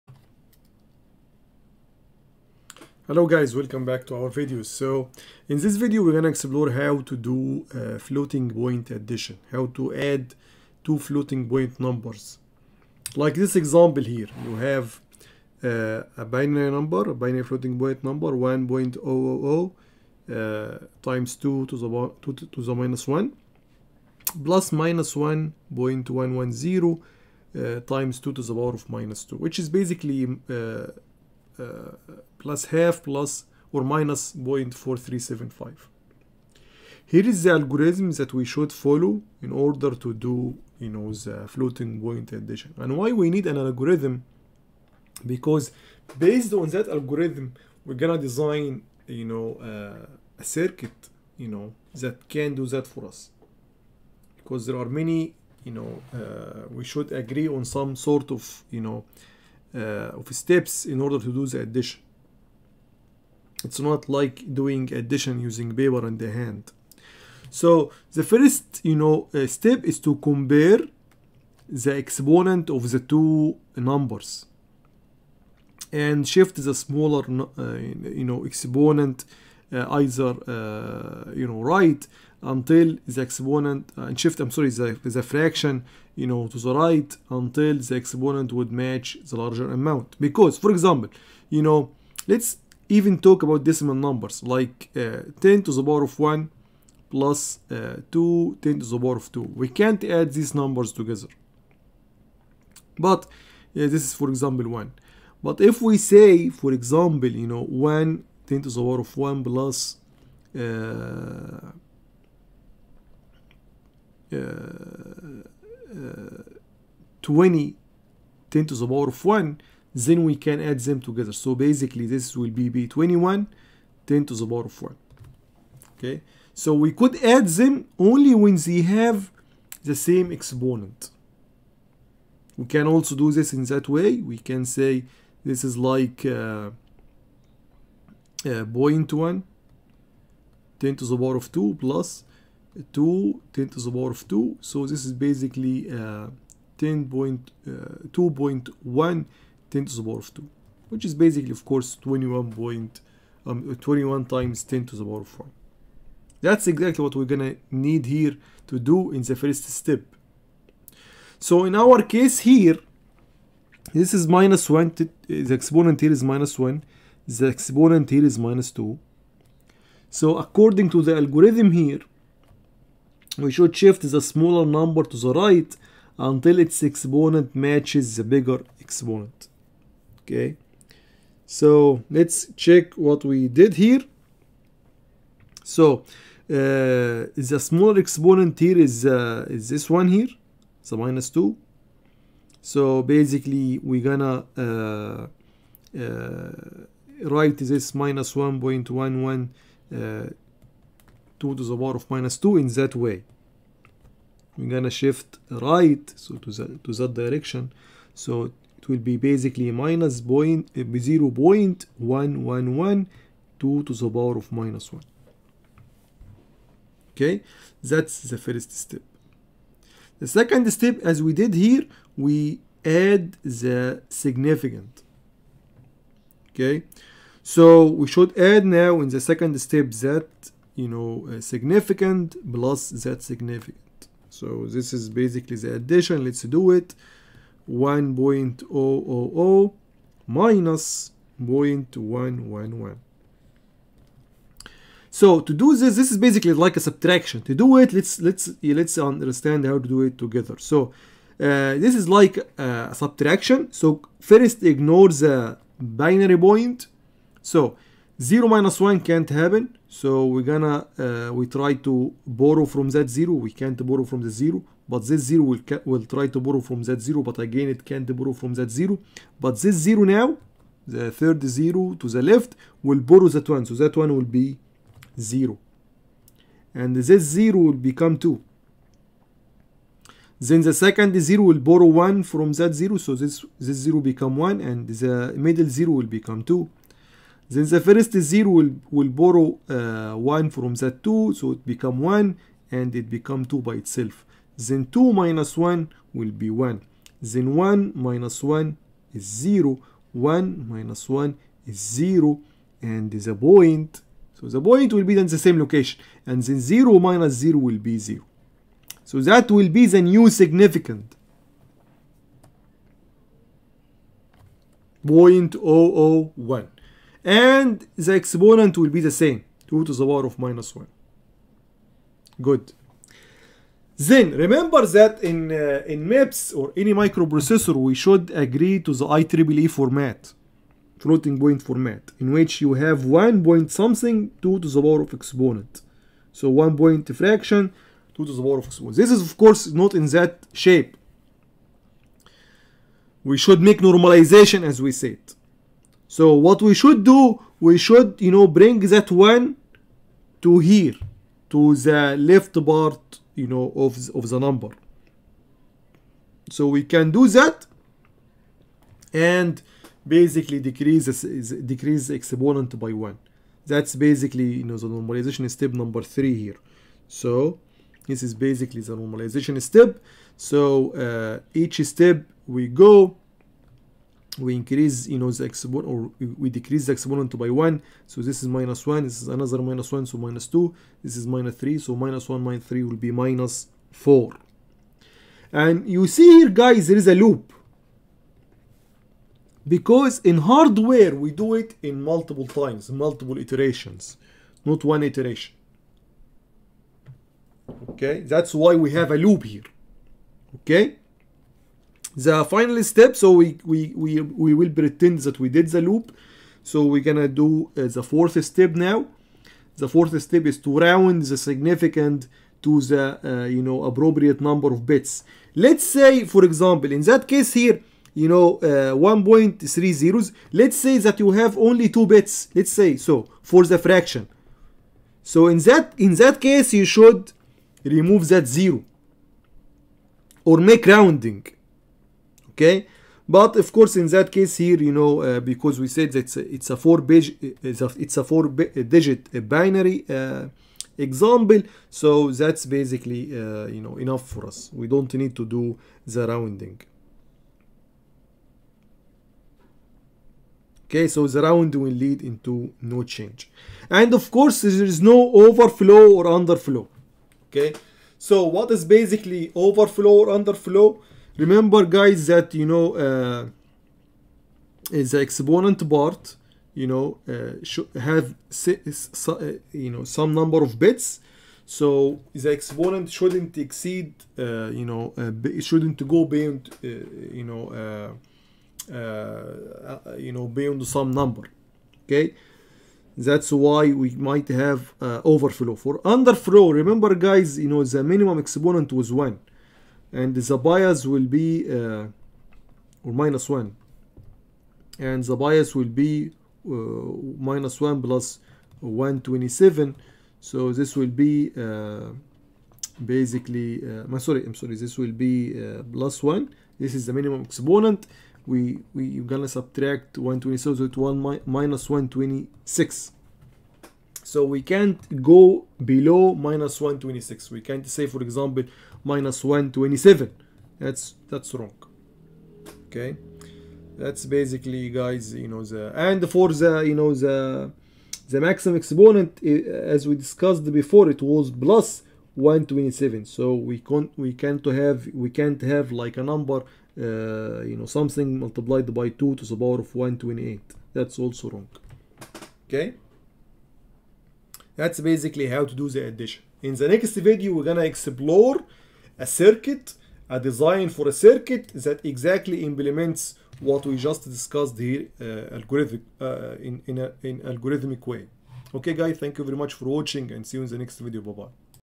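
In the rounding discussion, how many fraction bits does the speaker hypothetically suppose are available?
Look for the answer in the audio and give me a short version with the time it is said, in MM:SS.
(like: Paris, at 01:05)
2, at 07:01.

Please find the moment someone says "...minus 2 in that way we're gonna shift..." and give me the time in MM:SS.
03:22.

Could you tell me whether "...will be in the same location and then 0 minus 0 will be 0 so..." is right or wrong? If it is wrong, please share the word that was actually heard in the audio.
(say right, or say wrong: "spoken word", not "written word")
right.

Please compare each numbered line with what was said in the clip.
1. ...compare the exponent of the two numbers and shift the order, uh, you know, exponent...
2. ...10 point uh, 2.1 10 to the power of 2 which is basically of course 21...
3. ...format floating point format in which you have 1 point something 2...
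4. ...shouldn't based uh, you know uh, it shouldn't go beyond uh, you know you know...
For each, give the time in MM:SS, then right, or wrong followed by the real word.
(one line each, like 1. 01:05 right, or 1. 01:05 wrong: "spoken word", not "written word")
1. 01:10 wrong: "smaller", not "order"
2. 02:26 right
3. 05:29 right
4. 07:53 wrong: "exceed", not "based".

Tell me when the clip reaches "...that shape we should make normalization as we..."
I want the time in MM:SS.
05:40.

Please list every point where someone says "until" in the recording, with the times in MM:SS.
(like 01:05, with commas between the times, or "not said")
01:22, 01:27, 02:56.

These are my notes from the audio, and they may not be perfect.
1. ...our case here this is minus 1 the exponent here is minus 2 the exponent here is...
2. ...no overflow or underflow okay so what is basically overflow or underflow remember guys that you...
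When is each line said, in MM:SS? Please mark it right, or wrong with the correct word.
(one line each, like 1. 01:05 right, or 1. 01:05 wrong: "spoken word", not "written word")
1. 02:41 wrong: "1", not "2"
2. 07:35 right.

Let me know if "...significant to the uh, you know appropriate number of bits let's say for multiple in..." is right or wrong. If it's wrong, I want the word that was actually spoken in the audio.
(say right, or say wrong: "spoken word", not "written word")
wrong: "example", not "multiple".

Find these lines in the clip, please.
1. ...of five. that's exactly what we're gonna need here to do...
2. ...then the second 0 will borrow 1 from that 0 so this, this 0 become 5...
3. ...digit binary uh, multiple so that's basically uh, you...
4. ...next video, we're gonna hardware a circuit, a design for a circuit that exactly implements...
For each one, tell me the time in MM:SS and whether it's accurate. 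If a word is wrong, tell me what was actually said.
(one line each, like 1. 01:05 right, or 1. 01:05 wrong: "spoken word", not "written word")
1. 02:35 wrong: "four", not "five"
2. 04:40 wrong: "1", not "5"
3. 07:18 wrong: "example", not "multiple"
4. 09:06 wrong: "explore", not "hardware".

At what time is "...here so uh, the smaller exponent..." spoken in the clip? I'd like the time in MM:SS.
03:03.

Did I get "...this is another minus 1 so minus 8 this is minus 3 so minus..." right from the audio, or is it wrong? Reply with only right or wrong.
wrong.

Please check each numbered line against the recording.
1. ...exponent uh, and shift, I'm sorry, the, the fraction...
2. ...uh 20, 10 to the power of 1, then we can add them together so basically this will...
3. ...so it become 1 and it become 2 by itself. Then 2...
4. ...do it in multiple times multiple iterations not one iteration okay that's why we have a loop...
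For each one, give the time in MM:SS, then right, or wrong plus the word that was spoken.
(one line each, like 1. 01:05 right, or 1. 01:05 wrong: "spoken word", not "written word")
1. 01:23 right
2. 01:55 right
3. 04:51 right
4. 06:31 right.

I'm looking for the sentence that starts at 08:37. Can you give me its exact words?
We can't say, for example, minus 127.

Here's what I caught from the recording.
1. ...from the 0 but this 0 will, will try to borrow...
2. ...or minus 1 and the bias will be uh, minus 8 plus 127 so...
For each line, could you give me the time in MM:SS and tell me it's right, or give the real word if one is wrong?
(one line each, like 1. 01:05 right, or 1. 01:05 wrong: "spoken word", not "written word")
1. 04:24 right
2. 08:13 wrong: "1", not "8".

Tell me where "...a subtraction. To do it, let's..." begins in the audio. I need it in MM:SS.
04:06.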